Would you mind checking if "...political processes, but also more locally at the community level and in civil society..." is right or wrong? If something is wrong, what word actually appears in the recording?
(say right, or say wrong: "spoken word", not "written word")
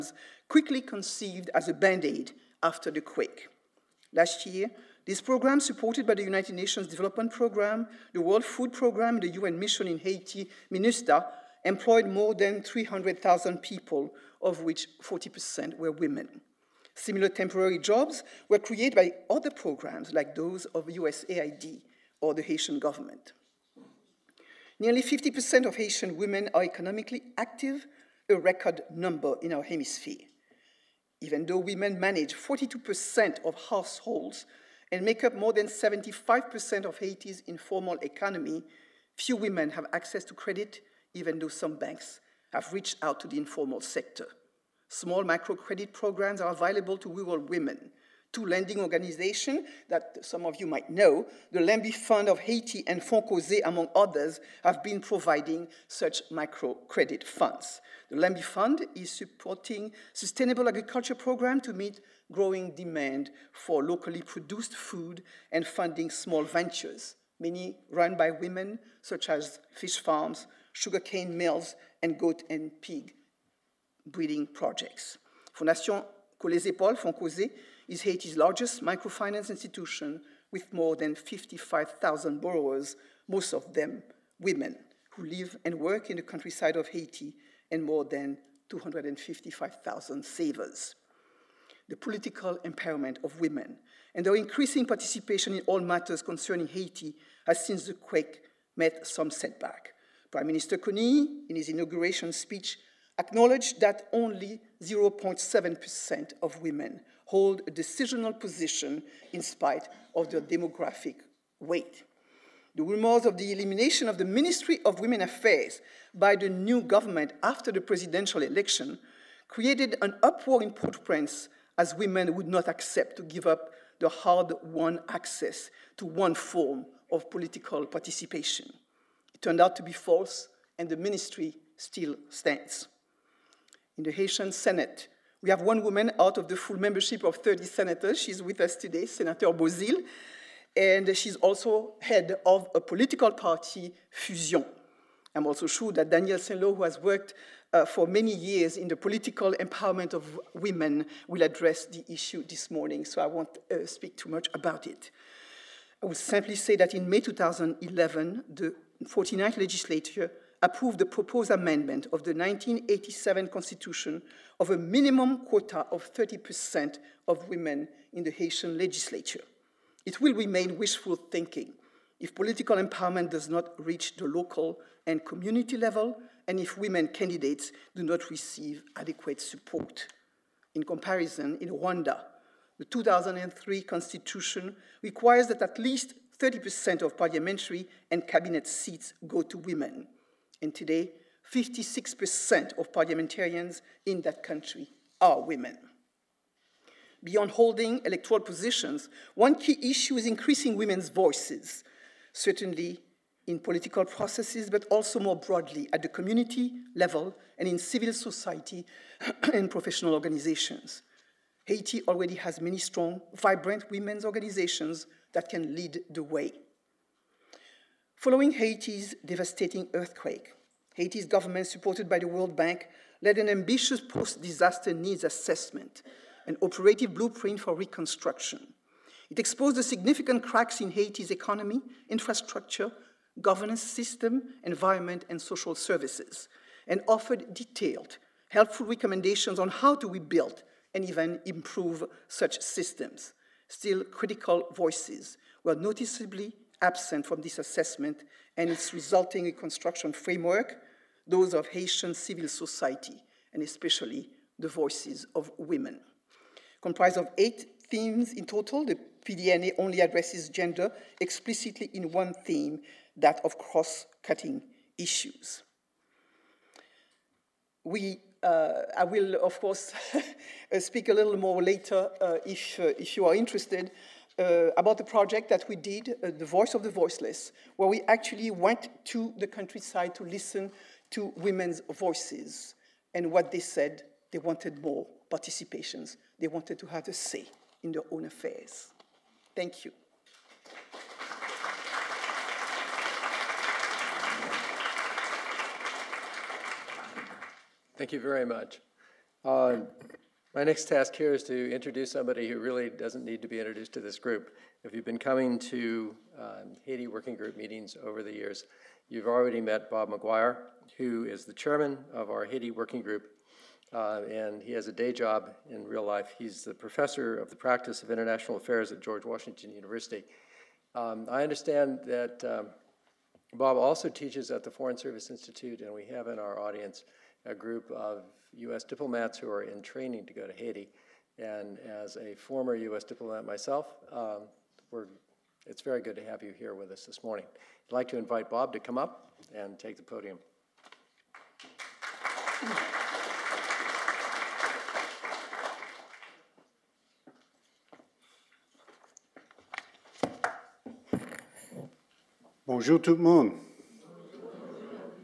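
wrong: "broadly", not "locally".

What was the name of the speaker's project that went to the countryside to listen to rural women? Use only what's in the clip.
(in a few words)
The Voice of the Voiceless.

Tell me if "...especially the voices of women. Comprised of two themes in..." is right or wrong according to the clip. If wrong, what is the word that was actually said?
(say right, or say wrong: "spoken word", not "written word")
wrong: "eight", not "two".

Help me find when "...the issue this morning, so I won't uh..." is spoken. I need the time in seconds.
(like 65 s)
151 s.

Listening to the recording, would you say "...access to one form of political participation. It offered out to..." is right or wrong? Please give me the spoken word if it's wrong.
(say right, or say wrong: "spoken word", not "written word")
wrong: "turned", not "offered".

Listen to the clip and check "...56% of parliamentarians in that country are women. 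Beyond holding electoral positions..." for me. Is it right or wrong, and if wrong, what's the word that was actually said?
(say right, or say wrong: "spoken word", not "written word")
right.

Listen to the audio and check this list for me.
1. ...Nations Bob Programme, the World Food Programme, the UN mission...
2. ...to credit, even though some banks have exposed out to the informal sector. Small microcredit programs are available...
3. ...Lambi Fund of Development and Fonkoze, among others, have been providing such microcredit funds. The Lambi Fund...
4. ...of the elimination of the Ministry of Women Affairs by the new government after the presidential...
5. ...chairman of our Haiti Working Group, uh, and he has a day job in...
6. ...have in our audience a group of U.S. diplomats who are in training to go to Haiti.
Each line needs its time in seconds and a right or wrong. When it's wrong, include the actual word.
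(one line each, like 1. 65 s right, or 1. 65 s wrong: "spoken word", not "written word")
1. 6 s wrong: "Development", not "Bob"
2. 40 s wrong: "reached", not "exposed"
3. 51 s wrong: "Haiti", not "Development"
4. 113 s right
5. 311 s right
6. 326 s right.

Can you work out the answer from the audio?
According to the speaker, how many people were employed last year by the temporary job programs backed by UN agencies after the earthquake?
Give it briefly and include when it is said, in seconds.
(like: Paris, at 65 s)
300,000, at 12 s.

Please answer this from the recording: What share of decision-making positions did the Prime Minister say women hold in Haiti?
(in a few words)
0.7%.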